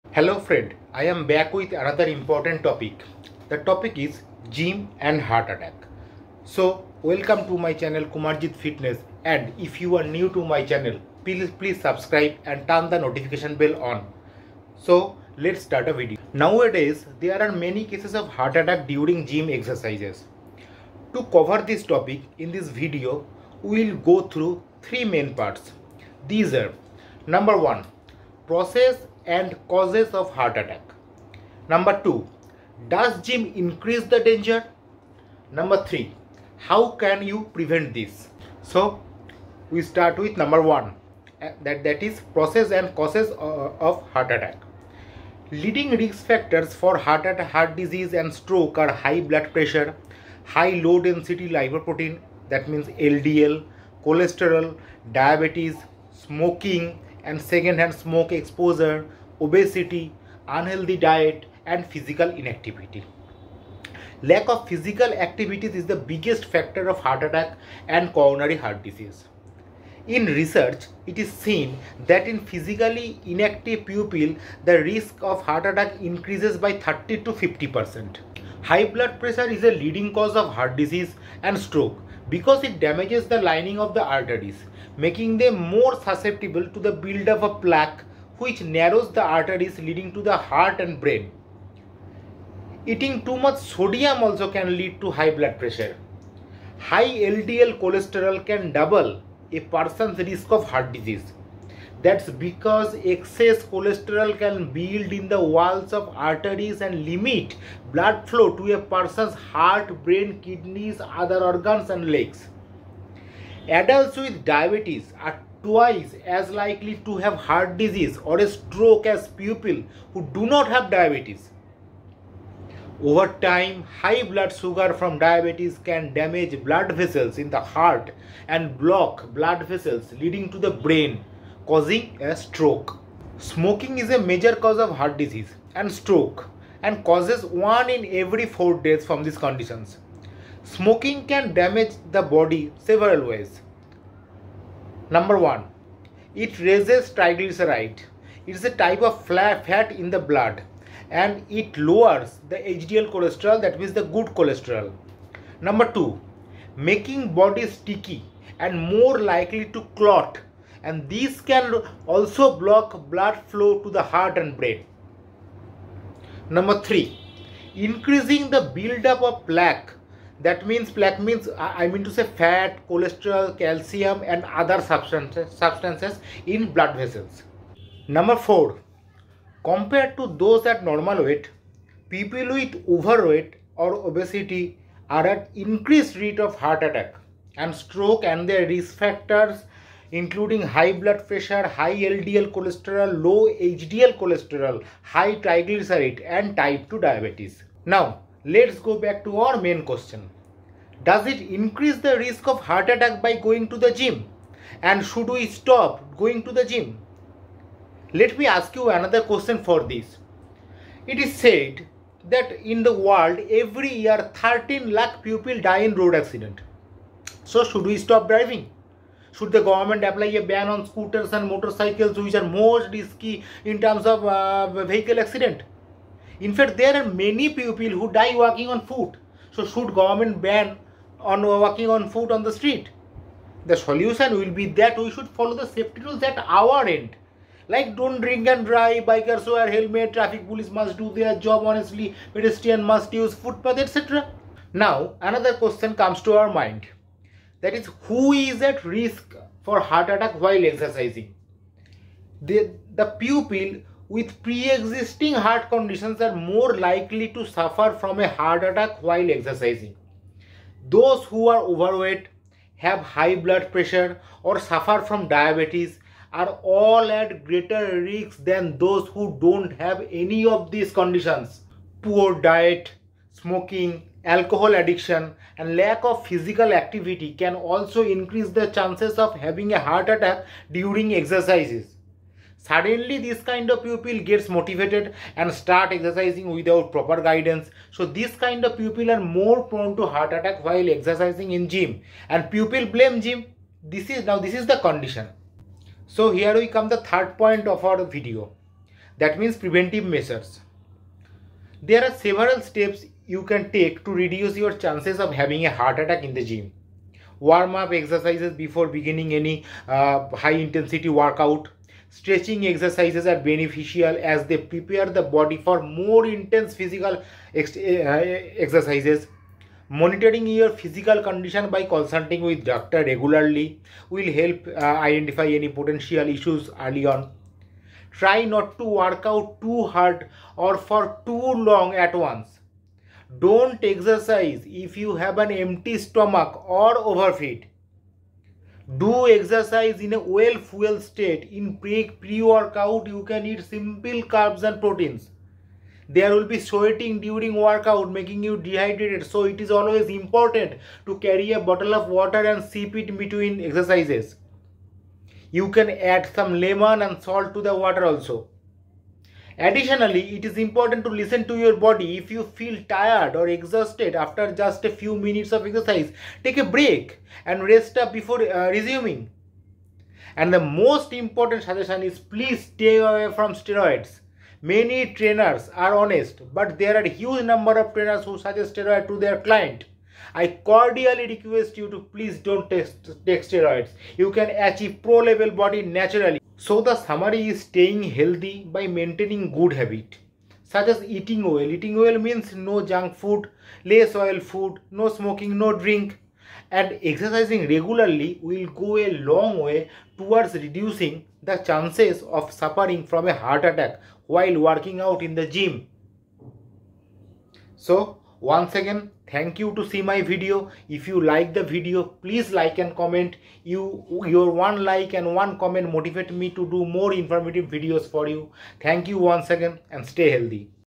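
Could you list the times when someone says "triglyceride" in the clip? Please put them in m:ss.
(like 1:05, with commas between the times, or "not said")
2:27, 3:15.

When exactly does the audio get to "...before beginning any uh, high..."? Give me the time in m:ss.
5:08.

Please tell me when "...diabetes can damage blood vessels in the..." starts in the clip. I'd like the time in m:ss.
2:05.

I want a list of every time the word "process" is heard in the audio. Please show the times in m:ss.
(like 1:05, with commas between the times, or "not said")
0:28, 0:42.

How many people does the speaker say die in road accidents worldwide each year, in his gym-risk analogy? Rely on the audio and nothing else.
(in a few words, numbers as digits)
13 lakh.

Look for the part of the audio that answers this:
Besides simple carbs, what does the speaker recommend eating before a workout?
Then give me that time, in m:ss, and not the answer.
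5:44.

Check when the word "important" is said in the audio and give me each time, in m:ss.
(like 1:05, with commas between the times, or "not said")
0:02, 5:50, 6:00, 6:11.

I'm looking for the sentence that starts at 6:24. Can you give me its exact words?
You can achieve pro level body naturally.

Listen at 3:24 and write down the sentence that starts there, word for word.
And should we stop going to the gym?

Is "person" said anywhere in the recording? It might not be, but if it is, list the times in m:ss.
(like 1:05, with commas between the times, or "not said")
1:39, 1:48.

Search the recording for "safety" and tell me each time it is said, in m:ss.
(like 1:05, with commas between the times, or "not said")
3:55.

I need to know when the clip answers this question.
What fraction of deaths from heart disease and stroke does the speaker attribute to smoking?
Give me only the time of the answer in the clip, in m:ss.
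2:17.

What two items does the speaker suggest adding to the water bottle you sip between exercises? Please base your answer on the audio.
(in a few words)
lemon and salt.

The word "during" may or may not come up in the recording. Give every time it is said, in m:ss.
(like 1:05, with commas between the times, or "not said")
0:18, 4:40, 5:47.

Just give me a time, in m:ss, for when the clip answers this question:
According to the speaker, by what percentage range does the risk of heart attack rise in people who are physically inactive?
1:16.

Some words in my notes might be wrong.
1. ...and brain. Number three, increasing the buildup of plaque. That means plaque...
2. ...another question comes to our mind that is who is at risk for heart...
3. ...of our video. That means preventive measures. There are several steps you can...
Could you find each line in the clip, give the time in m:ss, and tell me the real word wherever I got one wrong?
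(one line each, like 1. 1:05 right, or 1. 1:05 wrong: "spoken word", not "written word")
1. 2:44 right
2. 4:05 right
3. 4:57 right.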